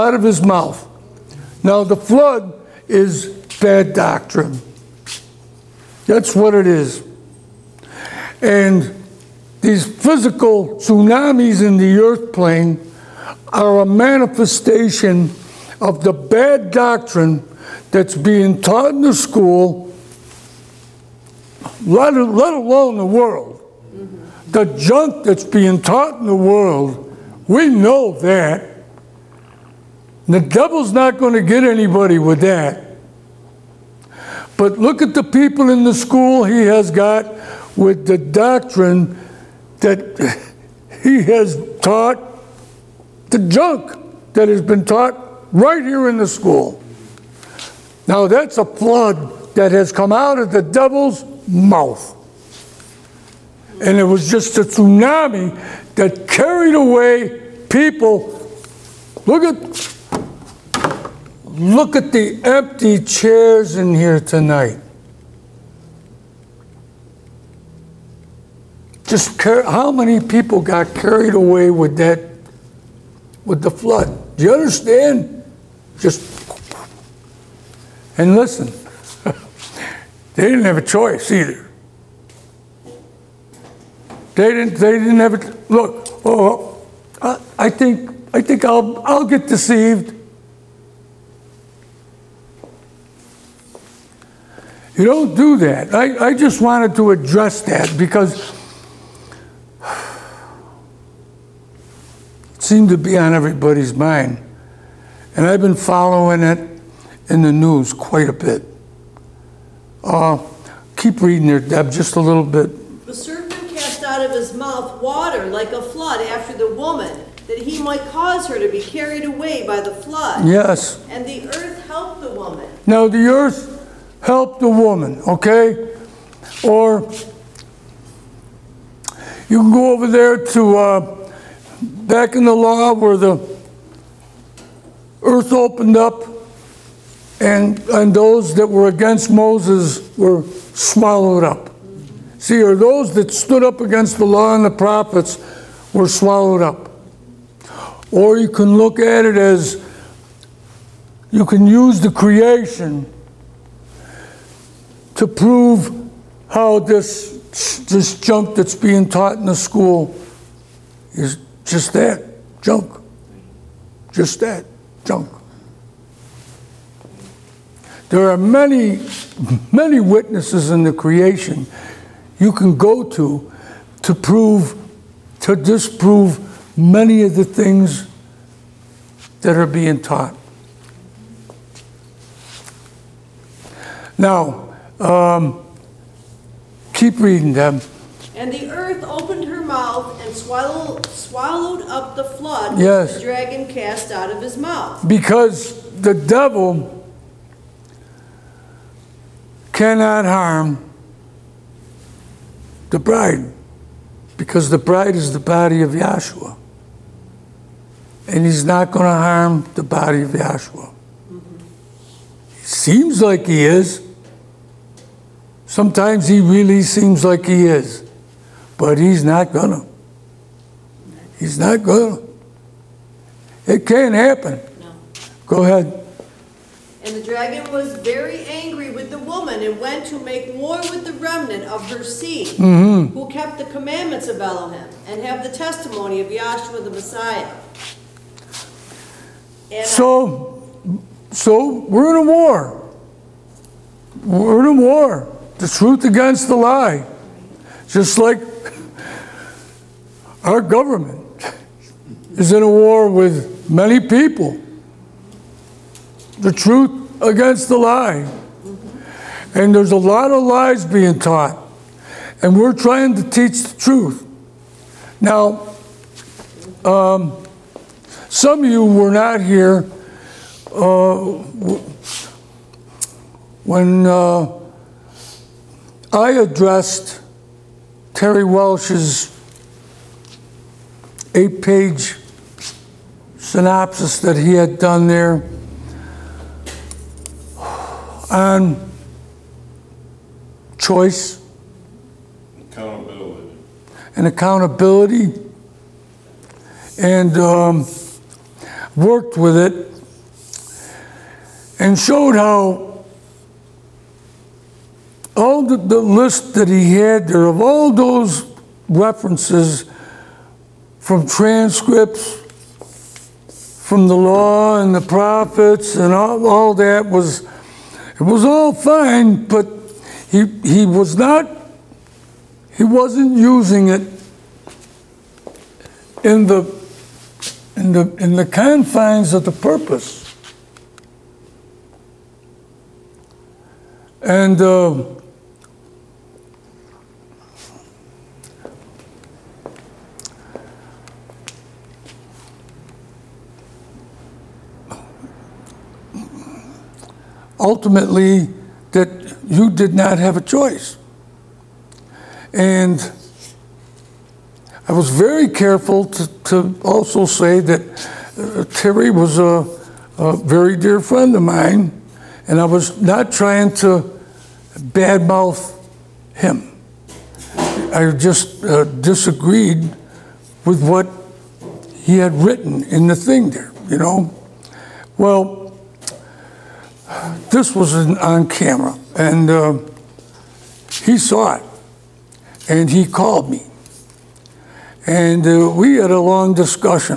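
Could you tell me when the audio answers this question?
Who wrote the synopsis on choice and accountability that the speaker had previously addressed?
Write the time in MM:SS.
04:38.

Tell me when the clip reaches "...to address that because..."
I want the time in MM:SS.
01:36.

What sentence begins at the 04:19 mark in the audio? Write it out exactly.
And there's a lot of lies being taught.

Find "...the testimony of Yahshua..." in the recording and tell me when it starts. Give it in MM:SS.
03:55.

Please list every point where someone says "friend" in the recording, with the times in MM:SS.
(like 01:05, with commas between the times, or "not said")
06:00.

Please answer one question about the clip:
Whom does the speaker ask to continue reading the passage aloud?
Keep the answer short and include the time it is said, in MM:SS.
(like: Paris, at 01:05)
Deb, at 01:51.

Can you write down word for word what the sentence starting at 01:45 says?
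And I've been following it in the news quite a bit.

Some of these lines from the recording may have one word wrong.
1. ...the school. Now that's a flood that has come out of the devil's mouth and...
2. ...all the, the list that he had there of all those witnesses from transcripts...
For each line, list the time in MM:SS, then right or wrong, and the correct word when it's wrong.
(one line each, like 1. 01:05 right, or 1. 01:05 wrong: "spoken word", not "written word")
1. 00:46 right
2. 05:05 wrong: "references", not "witnesses".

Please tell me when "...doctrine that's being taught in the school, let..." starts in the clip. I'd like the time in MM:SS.
00:16.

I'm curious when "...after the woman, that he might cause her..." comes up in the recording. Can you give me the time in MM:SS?
01:56.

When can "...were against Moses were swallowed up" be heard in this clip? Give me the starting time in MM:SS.
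02:18.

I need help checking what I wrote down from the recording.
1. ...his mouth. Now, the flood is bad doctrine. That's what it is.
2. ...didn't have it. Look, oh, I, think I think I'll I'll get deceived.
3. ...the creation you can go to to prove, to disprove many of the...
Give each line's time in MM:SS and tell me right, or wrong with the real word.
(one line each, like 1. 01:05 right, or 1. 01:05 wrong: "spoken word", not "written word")
1. 00:00 right
2. 01:24 right
3. 02:50 right.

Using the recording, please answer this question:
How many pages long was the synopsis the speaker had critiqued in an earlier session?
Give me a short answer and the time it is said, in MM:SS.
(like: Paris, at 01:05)
8, at 04:41.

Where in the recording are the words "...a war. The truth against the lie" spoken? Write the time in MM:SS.
04:04.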